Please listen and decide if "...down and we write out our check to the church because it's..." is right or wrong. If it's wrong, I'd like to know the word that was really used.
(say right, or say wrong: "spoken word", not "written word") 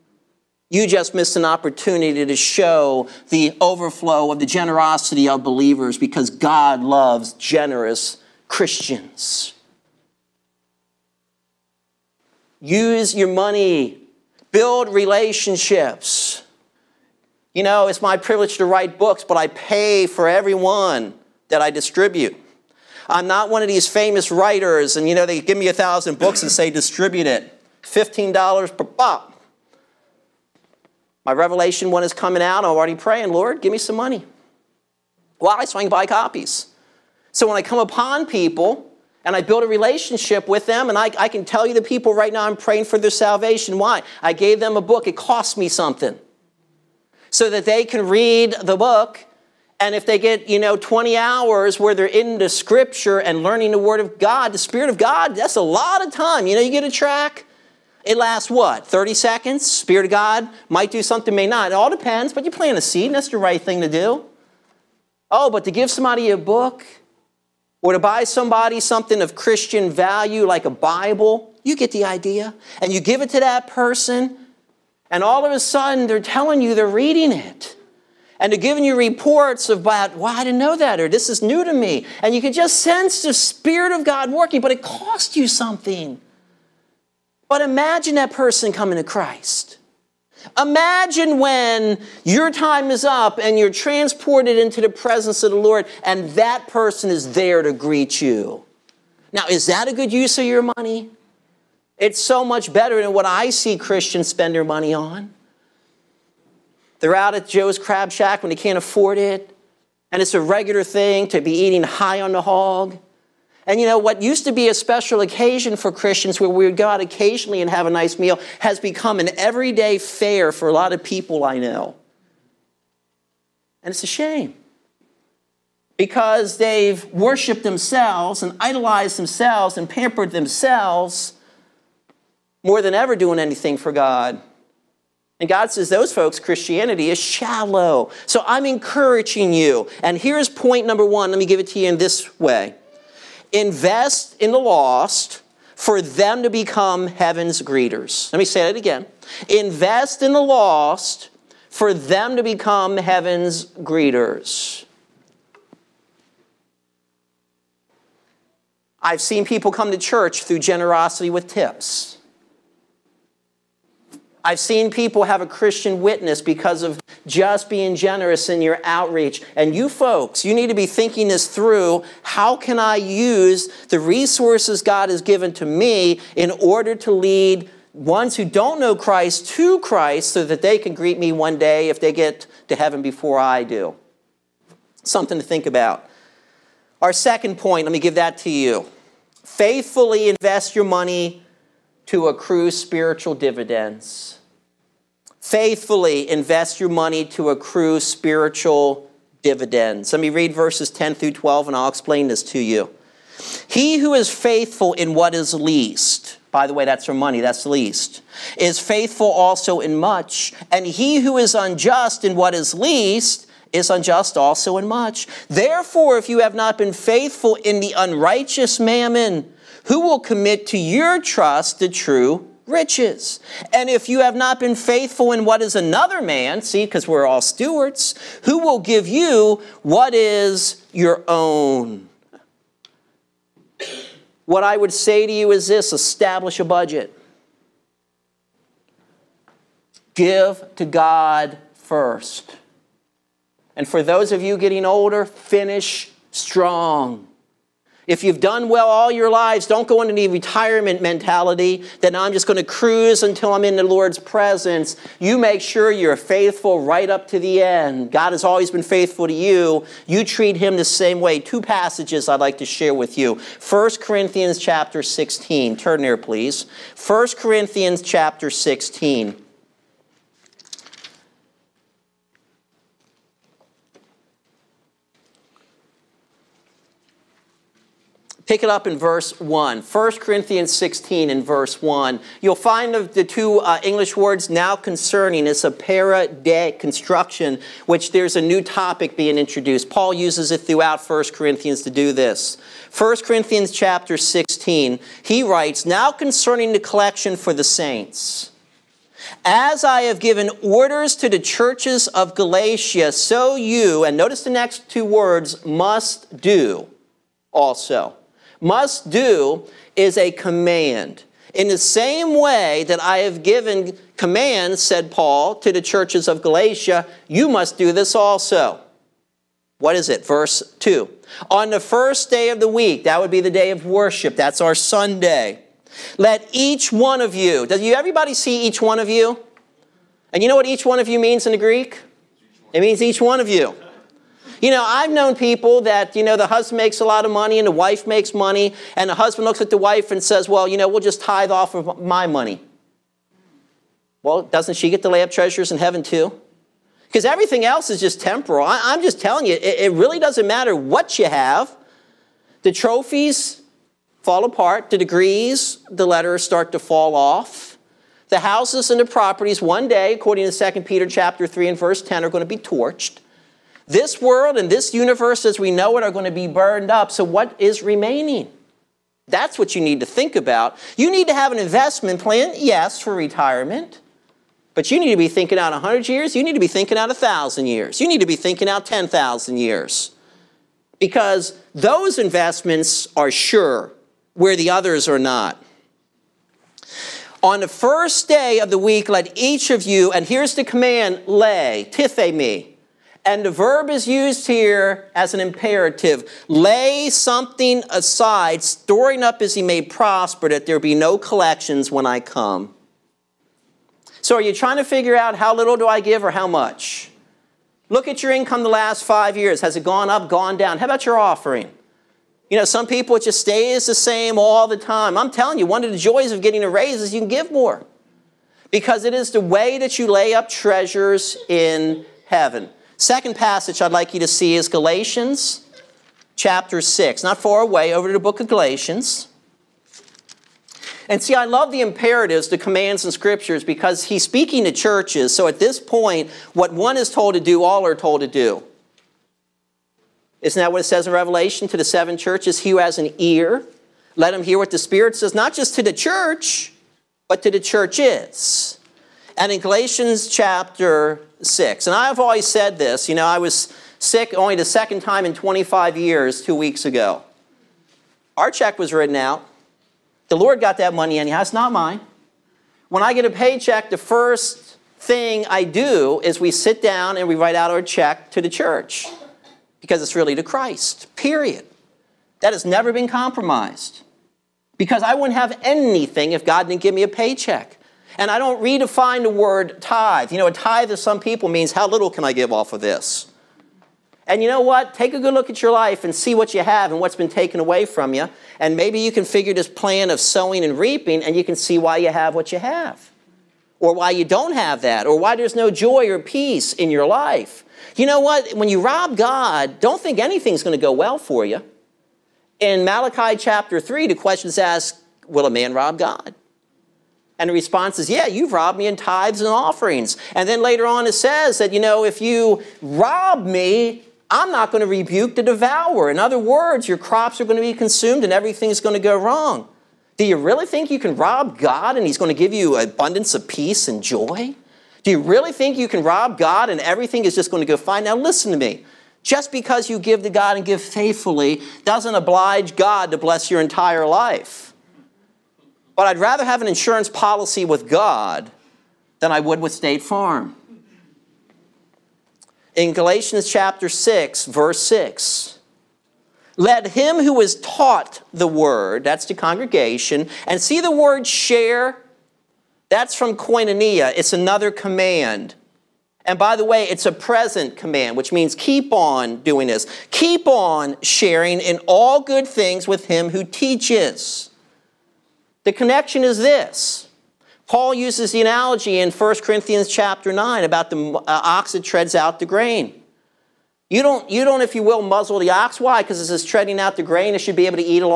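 right.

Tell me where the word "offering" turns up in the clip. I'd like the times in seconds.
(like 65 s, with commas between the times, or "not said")
411 s, 509 s.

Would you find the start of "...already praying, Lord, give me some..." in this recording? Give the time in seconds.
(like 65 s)
32 s.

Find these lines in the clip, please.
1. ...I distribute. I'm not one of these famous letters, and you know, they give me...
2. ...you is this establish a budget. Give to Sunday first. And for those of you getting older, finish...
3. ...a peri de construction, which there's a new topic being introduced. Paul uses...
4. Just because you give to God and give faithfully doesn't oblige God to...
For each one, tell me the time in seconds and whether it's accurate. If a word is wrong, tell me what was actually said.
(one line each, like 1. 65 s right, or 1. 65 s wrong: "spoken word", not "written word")
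1. 21 s wrong: "writers", not "letters"
2. 235 s wrong: "God", not "Sunday"
3. 285 s right
4. 529 s right.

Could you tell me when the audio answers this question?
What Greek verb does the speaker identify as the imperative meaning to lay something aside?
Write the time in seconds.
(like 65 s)
391 s.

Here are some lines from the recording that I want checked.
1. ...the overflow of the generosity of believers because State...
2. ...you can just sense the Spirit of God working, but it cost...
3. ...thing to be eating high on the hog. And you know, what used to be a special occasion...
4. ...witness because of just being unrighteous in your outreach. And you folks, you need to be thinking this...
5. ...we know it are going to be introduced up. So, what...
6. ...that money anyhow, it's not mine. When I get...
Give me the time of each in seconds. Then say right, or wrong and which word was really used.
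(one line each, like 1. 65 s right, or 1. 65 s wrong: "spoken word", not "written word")
1. 3 s wrong: "God", not "State"
2. 82 s right
3. 110 s right
4. 165 s wrong: "generous", not "unrighteous"
5. 365 s wrong: "burned", not "introduced"
6. 460 s right.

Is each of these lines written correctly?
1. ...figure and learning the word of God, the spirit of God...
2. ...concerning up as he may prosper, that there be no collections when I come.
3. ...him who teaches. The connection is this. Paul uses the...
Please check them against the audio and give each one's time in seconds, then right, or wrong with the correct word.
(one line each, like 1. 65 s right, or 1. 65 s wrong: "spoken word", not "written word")
1. 52 s wrong: "scripture", not "figure"
2. 398 s wrong: "storing", not "concerning"
3. 563 s right.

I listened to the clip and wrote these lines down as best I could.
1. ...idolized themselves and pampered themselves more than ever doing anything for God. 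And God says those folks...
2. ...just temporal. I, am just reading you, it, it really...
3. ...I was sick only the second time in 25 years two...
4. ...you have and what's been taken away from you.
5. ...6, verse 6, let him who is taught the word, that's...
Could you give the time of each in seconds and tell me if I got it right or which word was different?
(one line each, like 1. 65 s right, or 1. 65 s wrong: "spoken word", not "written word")
1. 128 s right
2. 347 s wrong: "telling", not "reading"
3. 453 s right
4. 486 s right
5. 543 s right.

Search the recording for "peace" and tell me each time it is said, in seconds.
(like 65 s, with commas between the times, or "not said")
496 s, 523 s.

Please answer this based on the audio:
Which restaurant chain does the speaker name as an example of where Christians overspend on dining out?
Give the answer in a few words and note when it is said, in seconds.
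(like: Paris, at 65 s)
Joe's Crab Shack, at 107 s.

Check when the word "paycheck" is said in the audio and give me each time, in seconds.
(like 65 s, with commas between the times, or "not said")
463 s, 477 s.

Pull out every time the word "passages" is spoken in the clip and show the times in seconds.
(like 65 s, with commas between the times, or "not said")
261 s, 423 s.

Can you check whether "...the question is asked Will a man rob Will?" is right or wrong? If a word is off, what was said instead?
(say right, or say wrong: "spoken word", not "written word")
wrong: "God", not "Will".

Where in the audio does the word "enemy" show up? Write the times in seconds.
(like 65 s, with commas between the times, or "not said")
not said.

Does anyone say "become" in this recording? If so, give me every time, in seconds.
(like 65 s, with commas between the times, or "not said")
118 s, 146 s, 152 s.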